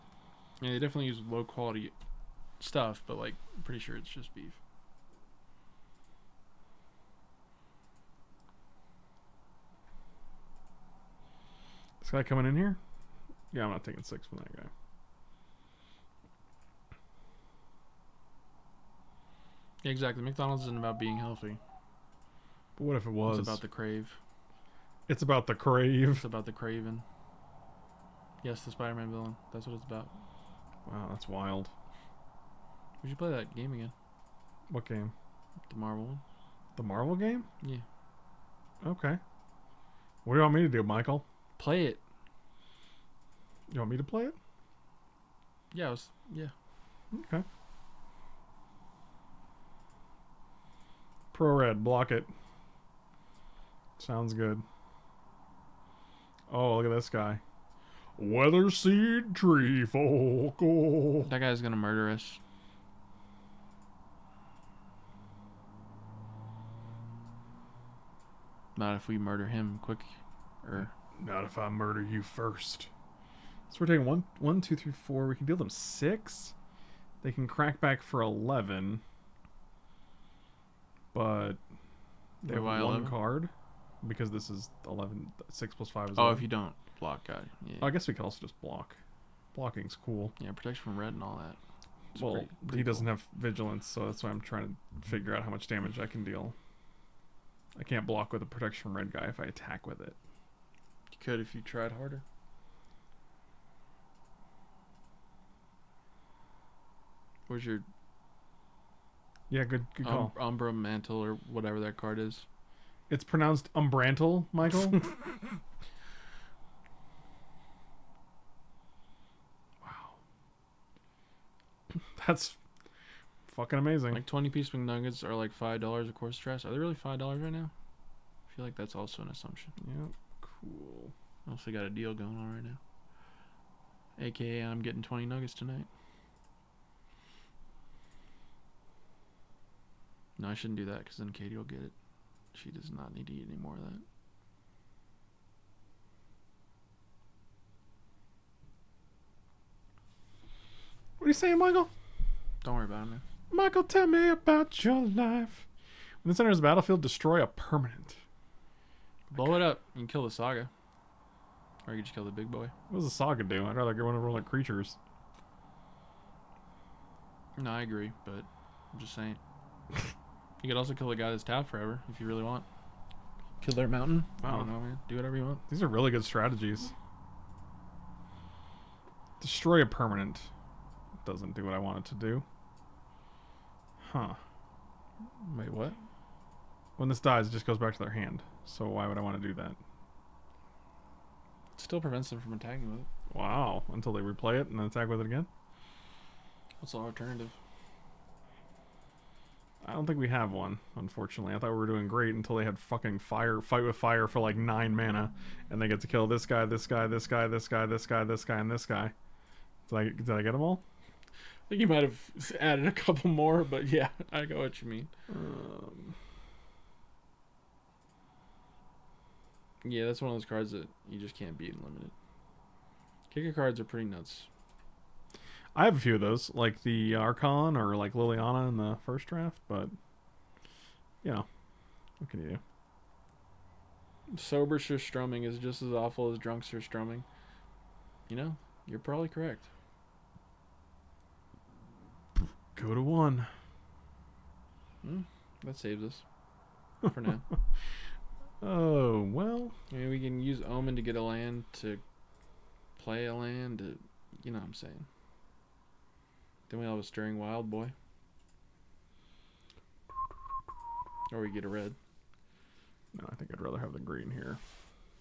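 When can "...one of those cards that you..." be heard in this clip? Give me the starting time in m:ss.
3:40.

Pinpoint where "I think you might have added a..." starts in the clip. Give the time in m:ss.
3:31.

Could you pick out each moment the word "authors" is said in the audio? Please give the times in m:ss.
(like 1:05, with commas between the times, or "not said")
not said.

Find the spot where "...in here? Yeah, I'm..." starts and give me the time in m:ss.
0:12.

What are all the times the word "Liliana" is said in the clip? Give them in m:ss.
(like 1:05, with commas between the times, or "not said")
3:48.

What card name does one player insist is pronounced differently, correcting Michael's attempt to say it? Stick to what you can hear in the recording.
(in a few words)
Umbrantle.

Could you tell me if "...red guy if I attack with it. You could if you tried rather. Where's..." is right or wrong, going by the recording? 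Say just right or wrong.
wrong.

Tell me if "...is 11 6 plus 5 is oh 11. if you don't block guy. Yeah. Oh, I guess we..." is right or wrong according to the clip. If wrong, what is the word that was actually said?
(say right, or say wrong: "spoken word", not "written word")
right.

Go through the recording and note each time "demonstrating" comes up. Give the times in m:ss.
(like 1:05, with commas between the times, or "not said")
not said.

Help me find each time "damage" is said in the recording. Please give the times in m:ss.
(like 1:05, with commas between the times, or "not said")
1:35.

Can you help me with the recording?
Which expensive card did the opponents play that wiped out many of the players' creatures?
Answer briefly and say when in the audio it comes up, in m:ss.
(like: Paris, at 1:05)
Fight with Fire, at 3:23.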